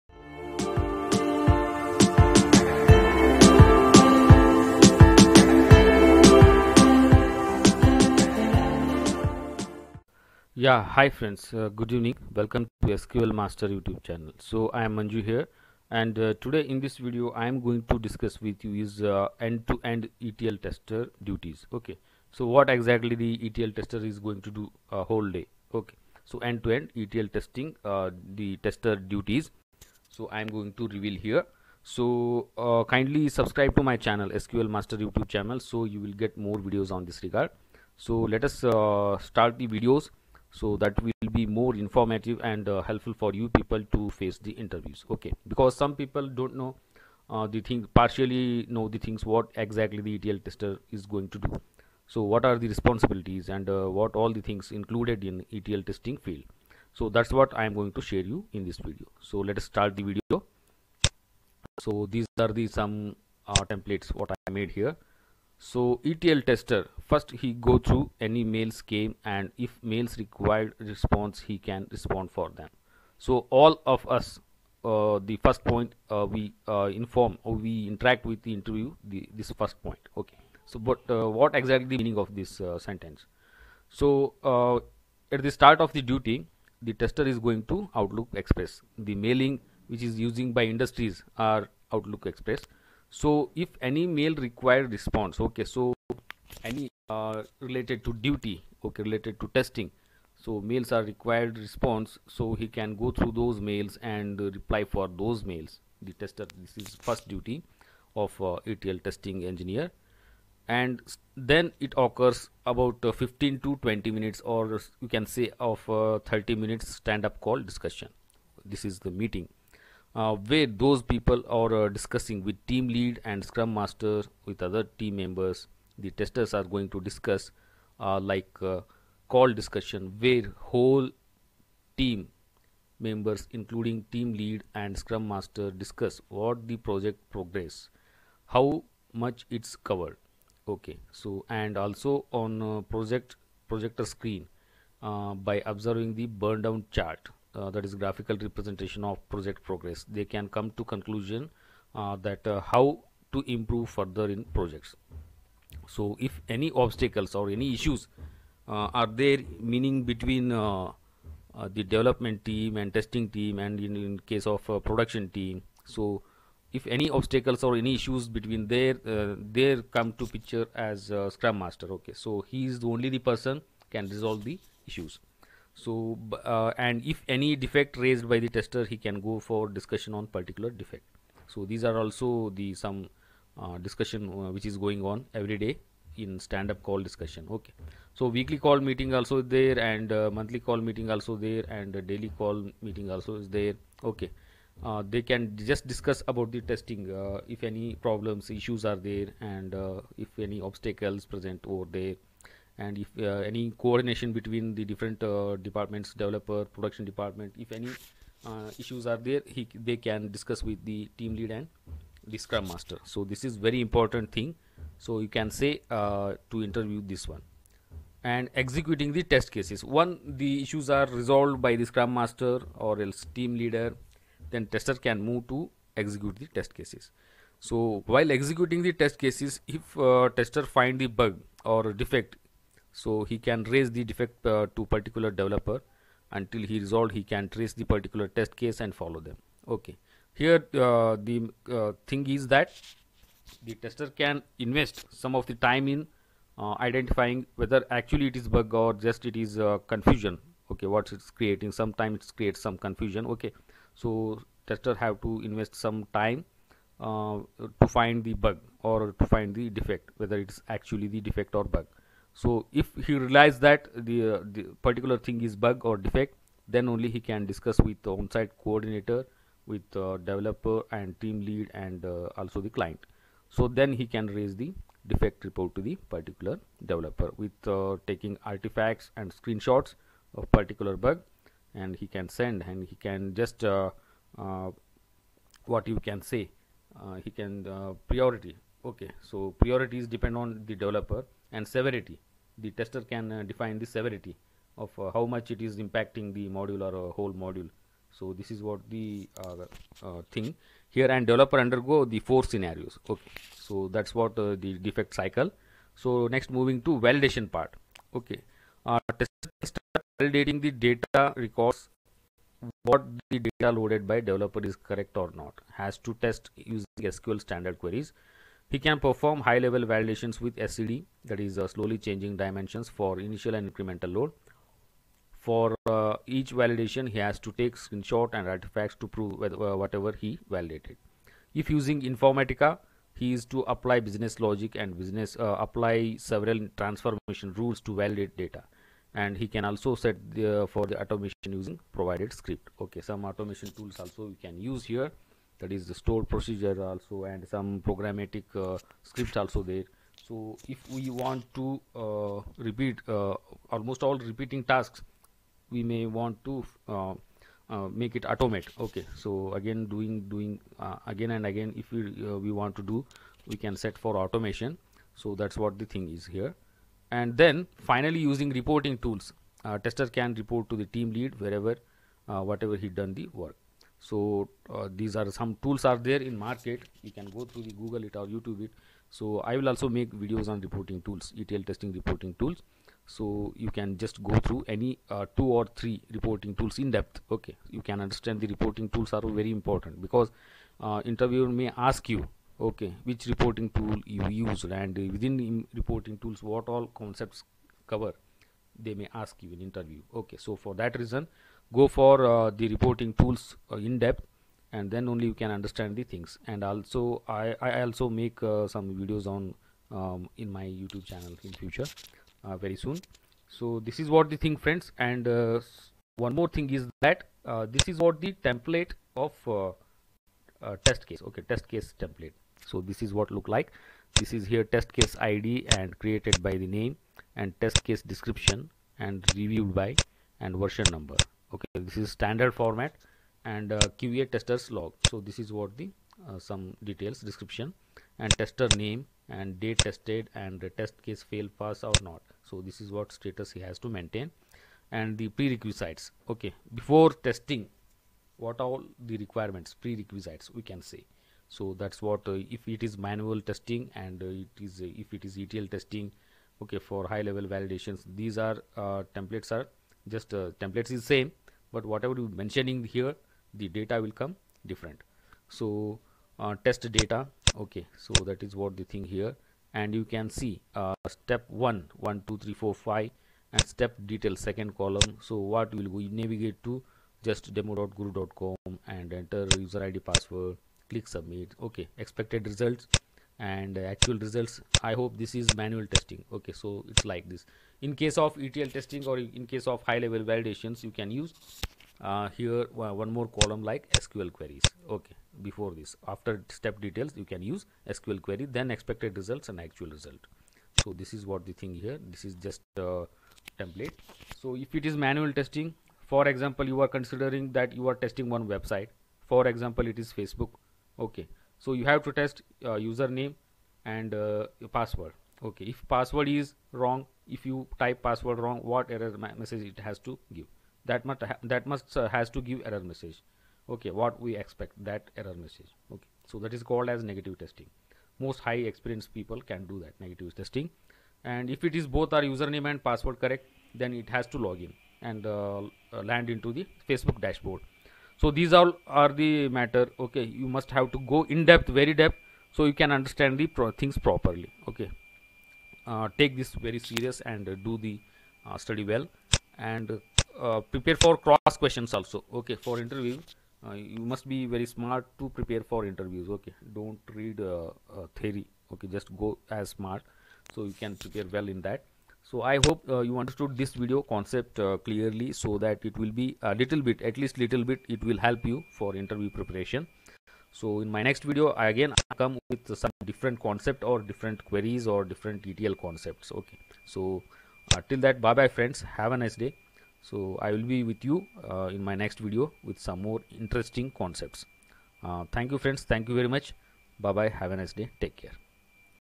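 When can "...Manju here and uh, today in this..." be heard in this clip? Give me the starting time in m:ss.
0:14.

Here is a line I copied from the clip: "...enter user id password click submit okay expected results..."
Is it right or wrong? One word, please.
right.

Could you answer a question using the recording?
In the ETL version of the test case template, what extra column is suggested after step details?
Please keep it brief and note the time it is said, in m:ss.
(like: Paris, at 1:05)
SQL queries, at 8:13.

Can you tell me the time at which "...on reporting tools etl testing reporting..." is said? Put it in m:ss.
6:20.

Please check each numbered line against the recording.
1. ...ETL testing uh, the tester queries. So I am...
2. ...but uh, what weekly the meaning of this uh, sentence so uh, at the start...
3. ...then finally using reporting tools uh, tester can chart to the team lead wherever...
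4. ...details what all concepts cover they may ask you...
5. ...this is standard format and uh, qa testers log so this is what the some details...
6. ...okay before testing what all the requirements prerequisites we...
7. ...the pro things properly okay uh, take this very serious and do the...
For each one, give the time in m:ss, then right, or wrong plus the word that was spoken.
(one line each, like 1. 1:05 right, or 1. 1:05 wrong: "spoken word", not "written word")
1. 0:27 wrong: "duties", not "queries"
2. 1:20 wrong: "exactly", not "weekly"
3. 6:07 wrong: "report", not "chart"
4. 6:36 wrong: "tools", not "details"
5. 7:11 right
6. 7:26 right
7. 9:03 right.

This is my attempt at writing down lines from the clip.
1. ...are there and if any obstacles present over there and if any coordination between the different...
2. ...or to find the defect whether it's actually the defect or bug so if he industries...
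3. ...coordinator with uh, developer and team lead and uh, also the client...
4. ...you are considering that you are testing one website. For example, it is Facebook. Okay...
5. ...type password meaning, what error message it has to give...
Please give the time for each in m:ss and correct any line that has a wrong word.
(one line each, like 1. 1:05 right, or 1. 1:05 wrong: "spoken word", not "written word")
1. 3:18 right
2. 4:18 wrong: "realizes", not "industries"
3. 4:28 right
4. 8:26 right
5. 8:37 wrong: "wrong", not "meaning".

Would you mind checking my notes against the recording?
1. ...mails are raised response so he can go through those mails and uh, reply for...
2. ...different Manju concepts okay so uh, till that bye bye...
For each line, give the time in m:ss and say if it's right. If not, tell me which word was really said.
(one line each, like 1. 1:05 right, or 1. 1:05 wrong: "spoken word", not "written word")
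1. 1:40 wrong: "required", not "raised"
2. 9:35 wrong: "ETL", not "Manju".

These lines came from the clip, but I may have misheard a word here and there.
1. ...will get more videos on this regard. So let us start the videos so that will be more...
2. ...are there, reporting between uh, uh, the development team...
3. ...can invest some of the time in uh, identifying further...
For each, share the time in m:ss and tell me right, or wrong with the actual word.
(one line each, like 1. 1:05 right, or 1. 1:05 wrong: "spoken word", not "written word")
1. 0:36 right
2. 2:38 wrong: "meaning", not "reporting"
3. 4:04 wrong: "whether", not "further".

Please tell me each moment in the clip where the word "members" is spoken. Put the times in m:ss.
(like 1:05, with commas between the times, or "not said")
2:05, 2:13.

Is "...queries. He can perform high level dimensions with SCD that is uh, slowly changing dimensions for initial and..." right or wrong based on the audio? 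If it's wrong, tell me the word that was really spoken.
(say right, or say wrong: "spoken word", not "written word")
wrong: "validations", not "dimensions".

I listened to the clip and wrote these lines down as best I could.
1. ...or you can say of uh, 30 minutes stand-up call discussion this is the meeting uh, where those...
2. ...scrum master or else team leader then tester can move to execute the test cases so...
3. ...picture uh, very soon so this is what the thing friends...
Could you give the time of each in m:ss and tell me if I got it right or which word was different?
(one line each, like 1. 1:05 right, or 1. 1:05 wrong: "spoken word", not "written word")
1. 1:54 right
2. 3:41 right
3. 6:51 wrong: "future", not "picture".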